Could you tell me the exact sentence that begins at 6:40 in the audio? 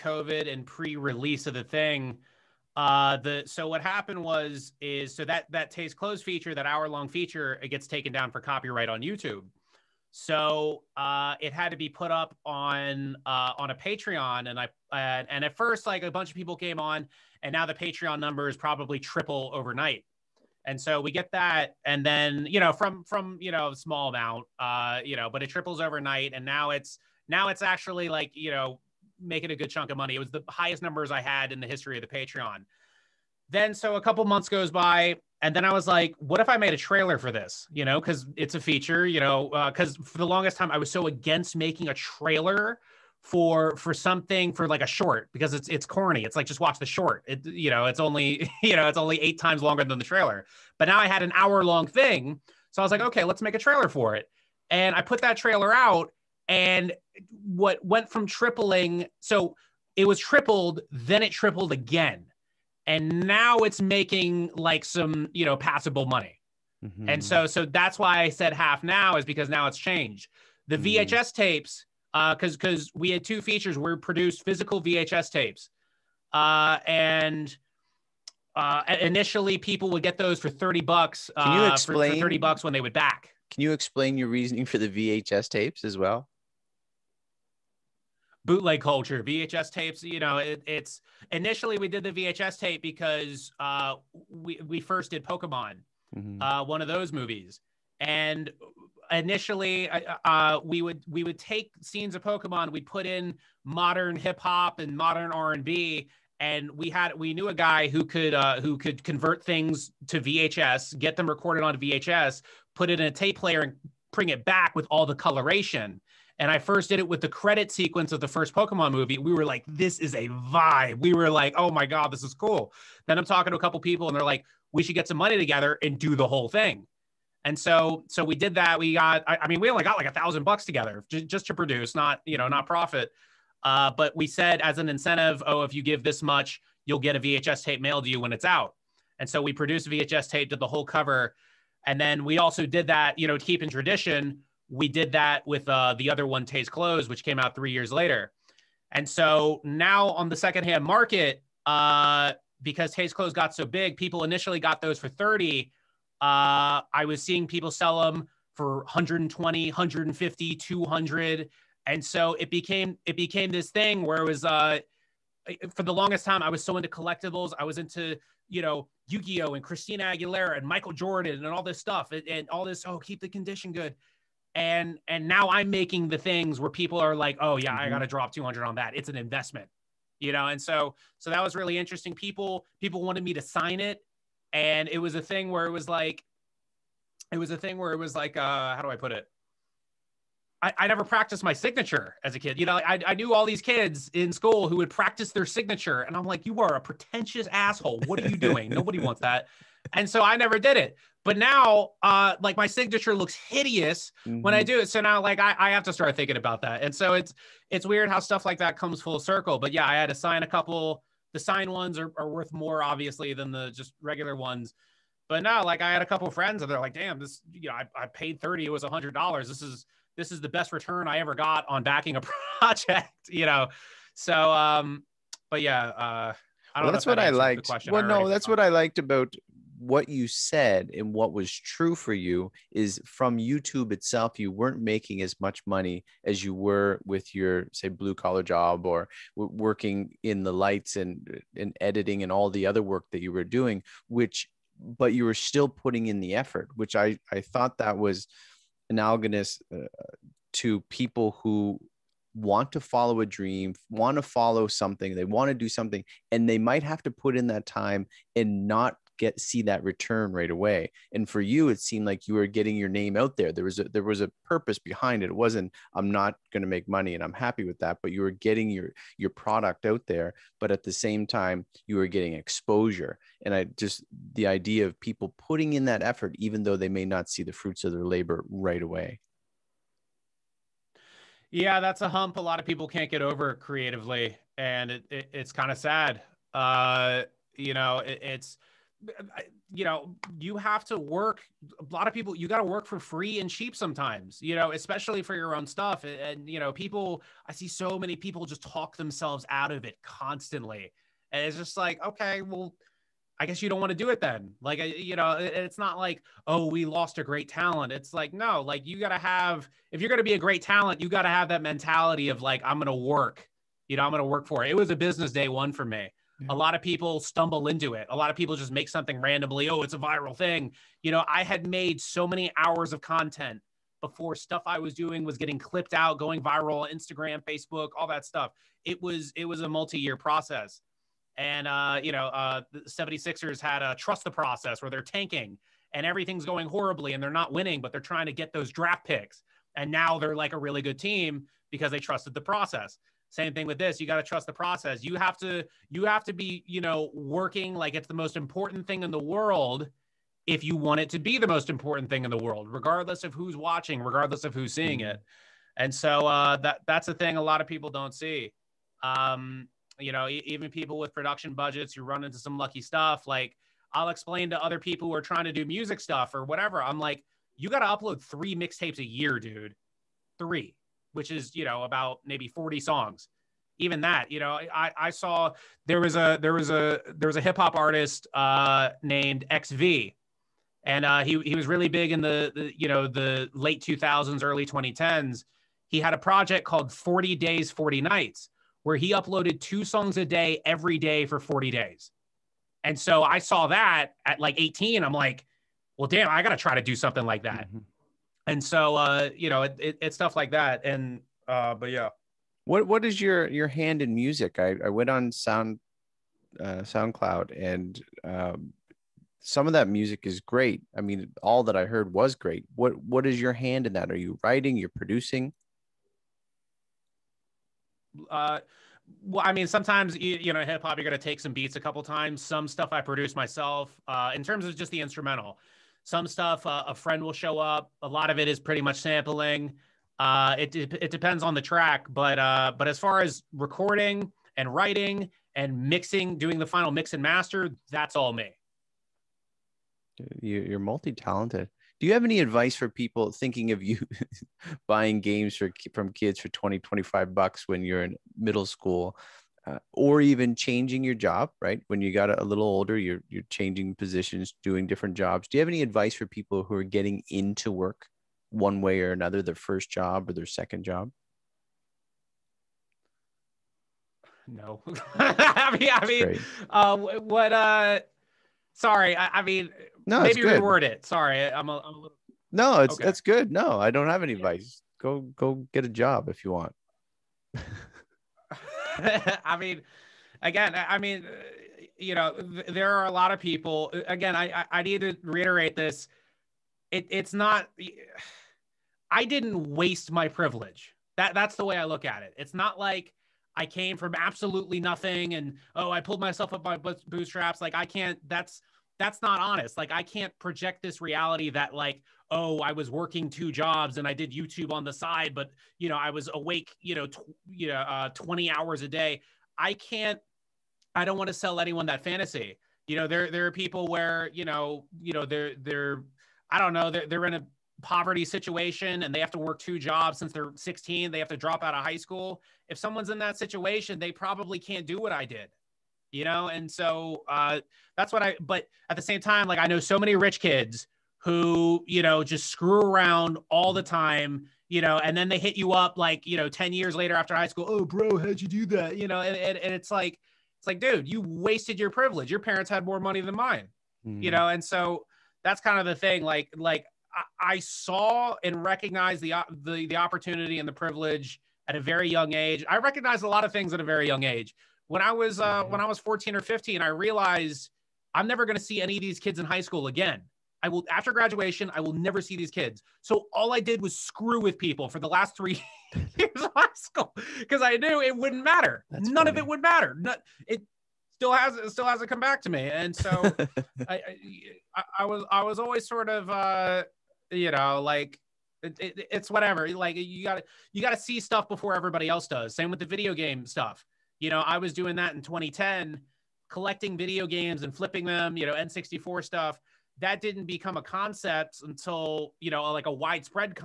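And uh, but yeah, what what is your your hand in music?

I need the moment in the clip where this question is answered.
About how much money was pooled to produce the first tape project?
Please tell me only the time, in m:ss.
2:10.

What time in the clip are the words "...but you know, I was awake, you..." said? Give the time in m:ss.
8:25.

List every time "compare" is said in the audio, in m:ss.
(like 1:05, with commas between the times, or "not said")
not said.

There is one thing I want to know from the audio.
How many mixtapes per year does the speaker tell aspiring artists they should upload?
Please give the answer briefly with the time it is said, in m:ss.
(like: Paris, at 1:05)
3, at 6:08.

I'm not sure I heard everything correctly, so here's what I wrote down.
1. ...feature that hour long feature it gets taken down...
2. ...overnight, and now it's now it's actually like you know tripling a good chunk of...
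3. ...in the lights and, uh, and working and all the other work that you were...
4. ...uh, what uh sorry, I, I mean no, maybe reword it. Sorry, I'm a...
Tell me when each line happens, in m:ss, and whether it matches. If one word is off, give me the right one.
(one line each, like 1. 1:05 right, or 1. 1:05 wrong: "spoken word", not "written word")
1. 0:06 right
2. 0:25 wrong: "making", not "tripling"
3. 4:00 wrong: "editing", not "working"
4. 7:46 right.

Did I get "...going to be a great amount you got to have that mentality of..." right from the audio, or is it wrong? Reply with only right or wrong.
wrong.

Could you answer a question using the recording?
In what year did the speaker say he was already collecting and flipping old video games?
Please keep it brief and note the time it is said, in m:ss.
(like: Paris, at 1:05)
2010, at 9:45.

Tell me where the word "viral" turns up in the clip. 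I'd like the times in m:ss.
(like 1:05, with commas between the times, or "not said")
5:19, 5:26.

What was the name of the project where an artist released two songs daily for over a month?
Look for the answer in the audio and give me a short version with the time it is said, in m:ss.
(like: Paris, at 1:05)
40 Days 40 Nights, at 6:26.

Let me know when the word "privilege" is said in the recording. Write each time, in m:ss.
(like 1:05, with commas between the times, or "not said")
8:10, 9:01, 9:10.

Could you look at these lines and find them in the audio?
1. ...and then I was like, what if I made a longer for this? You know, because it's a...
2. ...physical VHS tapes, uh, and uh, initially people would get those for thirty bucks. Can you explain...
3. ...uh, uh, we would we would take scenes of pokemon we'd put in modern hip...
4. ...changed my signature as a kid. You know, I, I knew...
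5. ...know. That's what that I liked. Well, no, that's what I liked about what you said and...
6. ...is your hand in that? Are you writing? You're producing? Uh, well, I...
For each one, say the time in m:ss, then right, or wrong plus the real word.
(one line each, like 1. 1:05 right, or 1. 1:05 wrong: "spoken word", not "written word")
1. 0:35 wrong: "trailer", not "longer"
2. 1:14 right
3. 1:39 right
4. 3:11 wrong: "practiced", not "changed"
5. 3:46 right
6. 6:53 right.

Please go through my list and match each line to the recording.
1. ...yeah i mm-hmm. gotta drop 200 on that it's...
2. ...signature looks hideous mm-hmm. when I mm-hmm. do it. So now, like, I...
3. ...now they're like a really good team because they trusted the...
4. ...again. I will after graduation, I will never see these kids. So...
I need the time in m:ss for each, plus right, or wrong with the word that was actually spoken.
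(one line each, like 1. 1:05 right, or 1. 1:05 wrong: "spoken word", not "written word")
1. 2:57 right
2. 3:22 right
3. 5:39 right
4. 9:19 right.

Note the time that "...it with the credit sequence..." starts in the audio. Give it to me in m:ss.
1:57.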